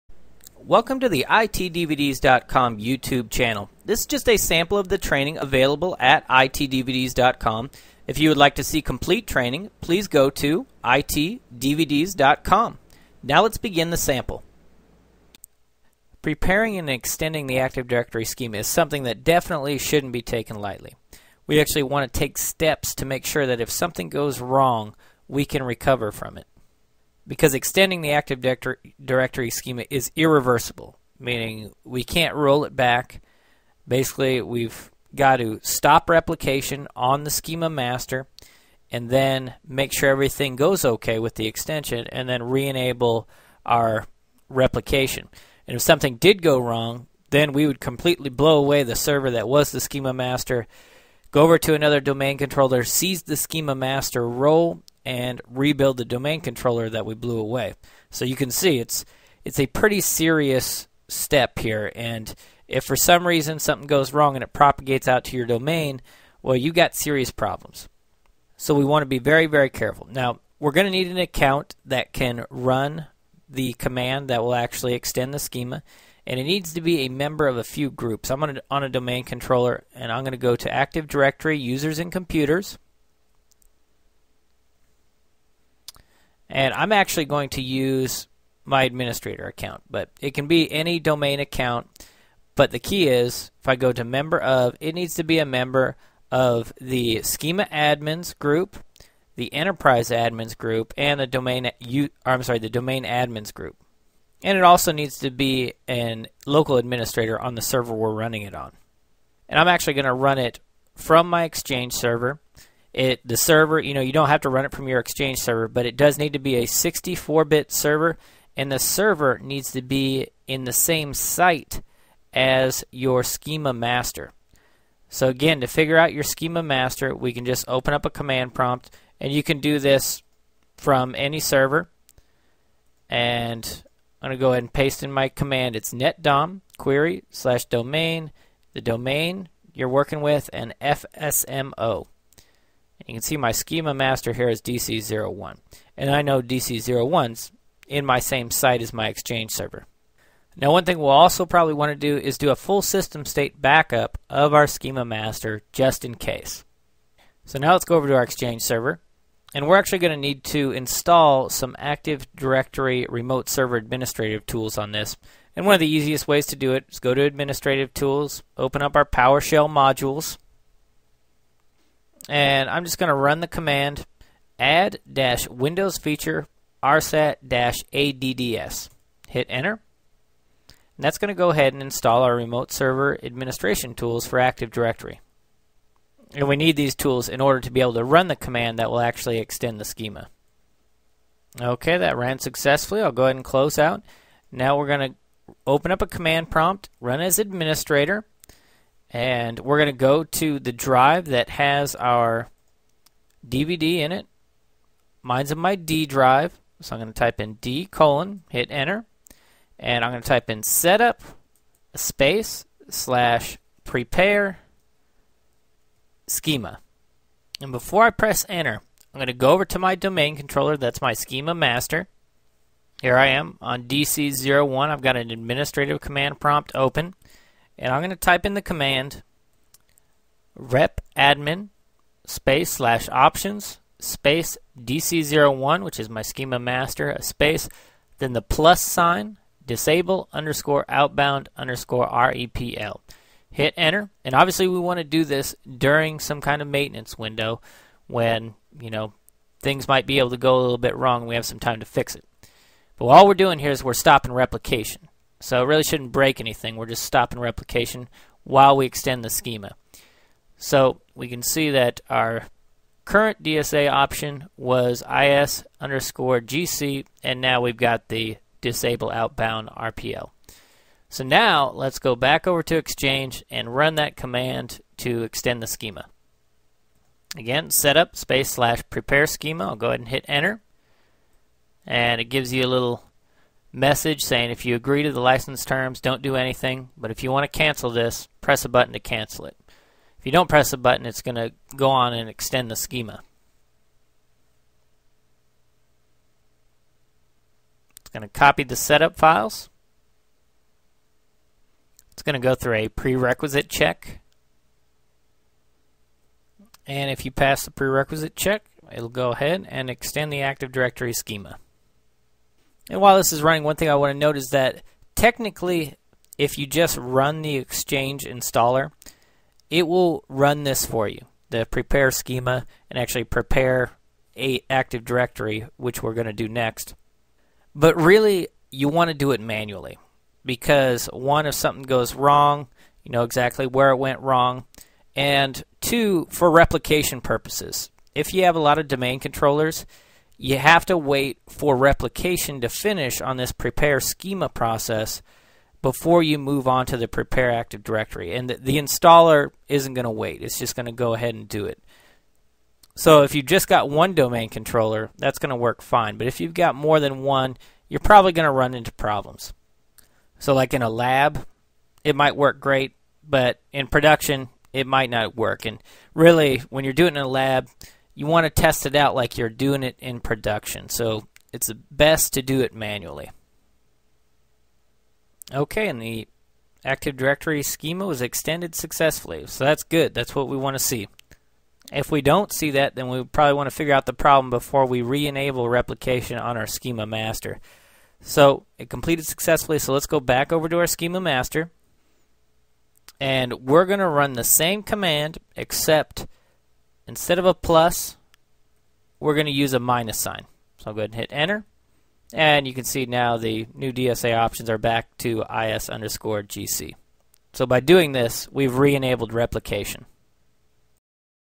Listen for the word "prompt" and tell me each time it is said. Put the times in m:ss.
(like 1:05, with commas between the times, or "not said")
2:08, 3:16, 3:46.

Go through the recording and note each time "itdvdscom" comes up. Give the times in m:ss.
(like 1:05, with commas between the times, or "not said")
0:01, 0:06, 0:10.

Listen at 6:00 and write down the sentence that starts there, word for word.
So like in a lab, it might work great, but in production, it might not work.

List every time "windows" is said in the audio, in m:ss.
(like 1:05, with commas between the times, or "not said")
2:55, 4:07.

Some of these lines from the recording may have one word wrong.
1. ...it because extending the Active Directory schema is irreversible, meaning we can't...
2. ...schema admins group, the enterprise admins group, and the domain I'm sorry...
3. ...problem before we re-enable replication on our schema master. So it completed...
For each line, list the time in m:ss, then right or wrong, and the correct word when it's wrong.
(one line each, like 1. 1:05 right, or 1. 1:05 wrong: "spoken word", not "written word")
1. 0:26 right
2. 1:37 right
3. 6:24 right.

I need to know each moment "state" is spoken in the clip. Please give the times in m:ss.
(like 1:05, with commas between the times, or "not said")
2:33.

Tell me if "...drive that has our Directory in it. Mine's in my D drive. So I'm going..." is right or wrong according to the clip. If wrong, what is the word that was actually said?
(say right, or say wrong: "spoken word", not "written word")
wrong: "DVD", not "Directory".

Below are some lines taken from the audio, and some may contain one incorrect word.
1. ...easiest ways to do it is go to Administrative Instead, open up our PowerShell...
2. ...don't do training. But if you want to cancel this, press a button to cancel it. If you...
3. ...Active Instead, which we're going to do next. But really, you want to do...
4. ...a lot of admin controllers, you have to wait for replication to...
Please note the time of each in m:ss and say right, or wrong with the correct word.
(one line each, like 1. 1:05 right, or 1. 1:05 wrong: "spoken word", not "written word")
1. 2:45 wrong: "Tools", not "Instead"
2. 4:46 wrong: "anything", not "training"
3. 5:24 wrong: "Directory", not "Instead"
4. 5:38 wrong: "domain", not "admin".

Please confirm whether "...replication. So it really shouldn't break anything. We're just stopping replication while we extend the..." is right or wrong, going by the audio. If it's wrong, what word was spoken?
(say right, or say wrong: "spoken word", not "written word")
right.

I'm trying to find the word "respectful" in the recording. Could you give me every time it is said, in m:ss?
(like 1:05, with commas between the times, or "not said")
not said.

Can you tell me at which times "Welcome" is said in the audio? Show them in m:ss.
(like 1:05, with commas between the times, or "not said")
0:00.